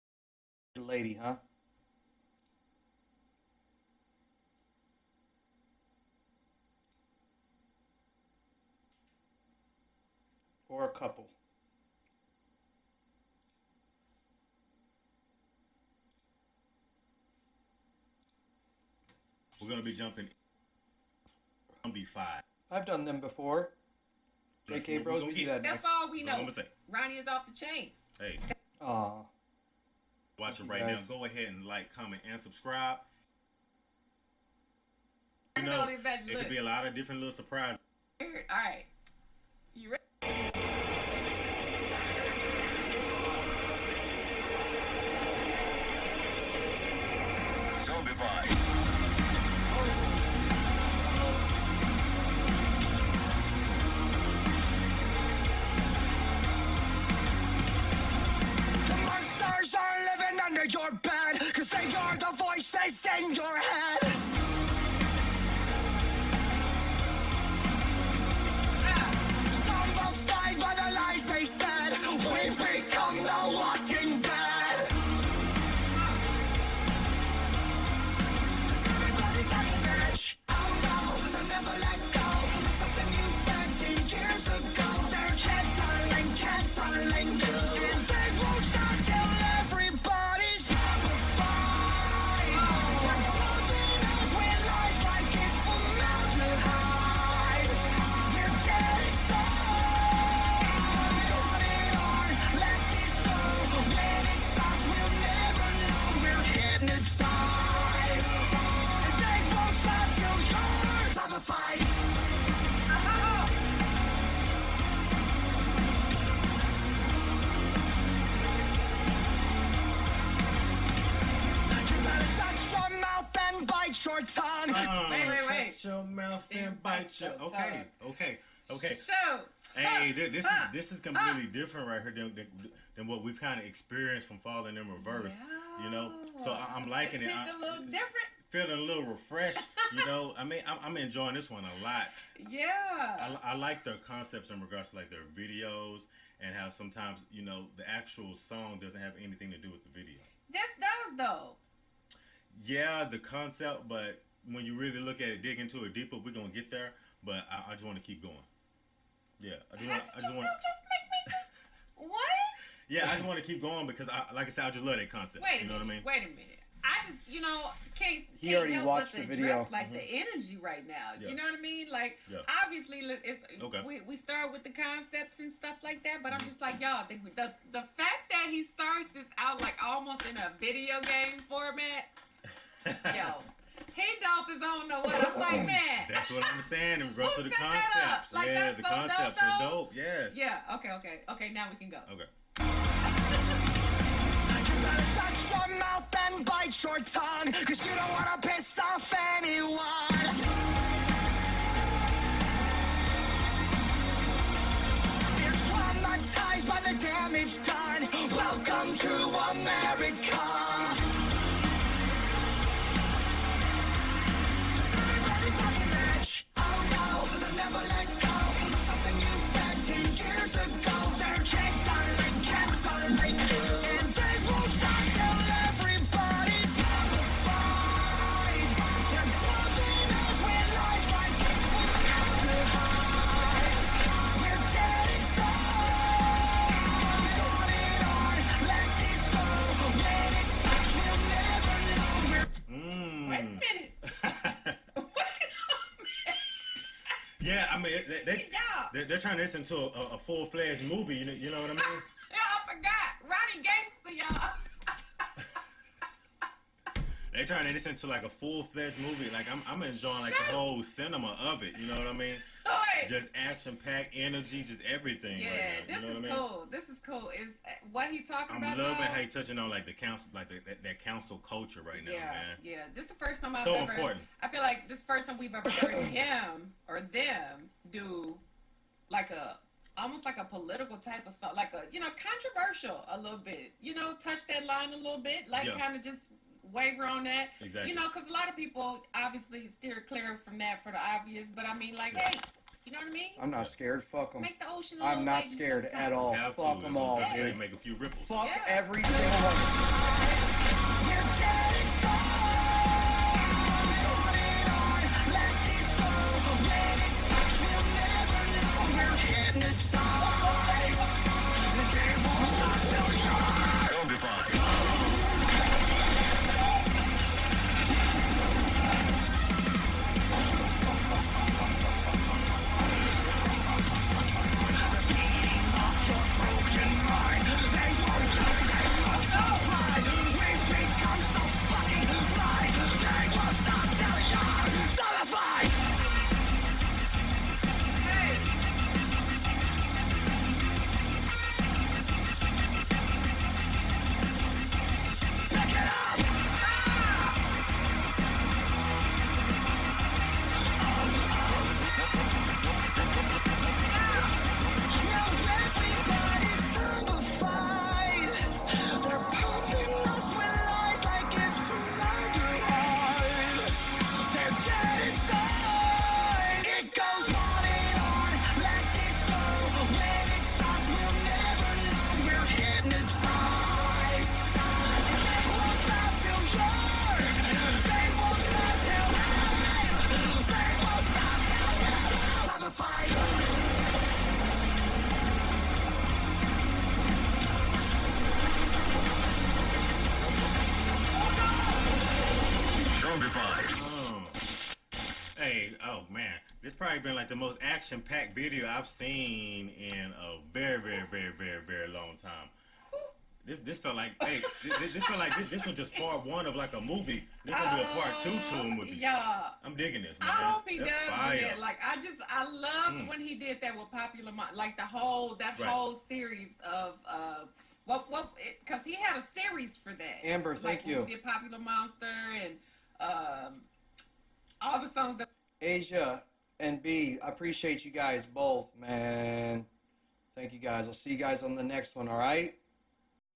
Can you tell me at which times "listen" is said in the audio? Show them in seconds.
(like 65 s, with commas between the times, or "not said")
249 s, 257 s.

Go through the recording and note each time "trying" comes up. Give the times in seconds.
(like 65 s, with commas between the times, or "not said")
249 s, 257 s.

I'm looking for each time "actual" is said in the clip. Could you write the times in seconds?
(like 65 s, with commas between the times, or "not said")
147 s.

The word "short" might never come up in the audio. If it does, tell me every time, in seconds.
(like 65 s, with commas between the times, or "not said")
124 s.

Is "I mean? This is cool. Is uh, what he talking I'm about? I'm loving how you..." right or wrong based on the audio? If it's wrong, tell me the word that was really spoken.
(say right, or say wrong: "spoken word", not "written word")
right.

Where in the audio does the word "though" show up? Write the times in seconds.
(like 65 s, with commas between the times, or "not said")
151 s.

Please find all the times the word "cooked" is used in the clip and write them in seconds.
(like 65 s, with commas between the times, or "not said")
not said.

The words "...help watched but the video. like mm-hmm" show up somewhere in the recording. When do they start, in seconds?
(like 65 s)
168 s.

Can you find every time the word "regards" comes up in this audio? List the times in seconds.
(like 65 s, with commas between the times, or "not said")
144 s, 187 s.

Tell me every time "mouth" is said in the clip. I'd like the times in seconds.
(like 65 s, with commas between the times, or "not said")
126 s, 195 s.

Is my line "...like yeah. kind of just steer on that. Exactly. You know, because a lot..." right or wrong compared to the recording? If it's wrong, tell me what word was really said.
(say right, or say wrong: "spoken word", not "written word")
wrong: "waver", not "steer".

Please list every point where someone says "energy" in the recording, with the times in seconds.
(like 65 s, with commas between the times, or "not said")
170 s, 264 s.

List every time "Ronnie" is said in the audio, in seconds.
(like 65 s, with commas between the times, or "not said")
26 s, 253 s.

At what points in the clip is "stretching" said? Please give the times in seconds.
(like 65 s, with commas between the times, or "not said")
not said.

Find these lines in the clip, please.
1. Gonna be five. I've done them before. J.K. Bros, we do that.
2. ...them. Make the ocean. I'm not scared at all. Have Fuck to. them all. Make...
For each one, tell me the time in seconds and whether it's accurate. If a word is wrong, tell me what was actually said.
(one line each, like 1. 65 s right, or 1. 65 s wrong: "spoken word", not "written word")
1. 21 s right
2. 294 s right.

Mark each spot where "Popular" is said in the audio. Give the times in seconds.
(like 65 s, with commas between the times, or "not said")
413 s, 421 s.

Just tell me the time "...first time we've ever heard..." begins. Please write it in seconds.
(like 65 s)
275 s.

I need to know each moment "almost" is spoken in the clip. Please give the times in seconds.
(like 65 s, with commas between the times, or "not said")
179 s, 279 s.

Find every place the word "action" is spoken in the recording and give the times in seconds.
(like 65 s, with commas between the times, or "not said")
263 s, 397 s.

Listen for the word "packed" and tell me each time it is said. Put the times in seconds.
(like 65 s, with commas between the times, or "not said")
263 s, 397 s.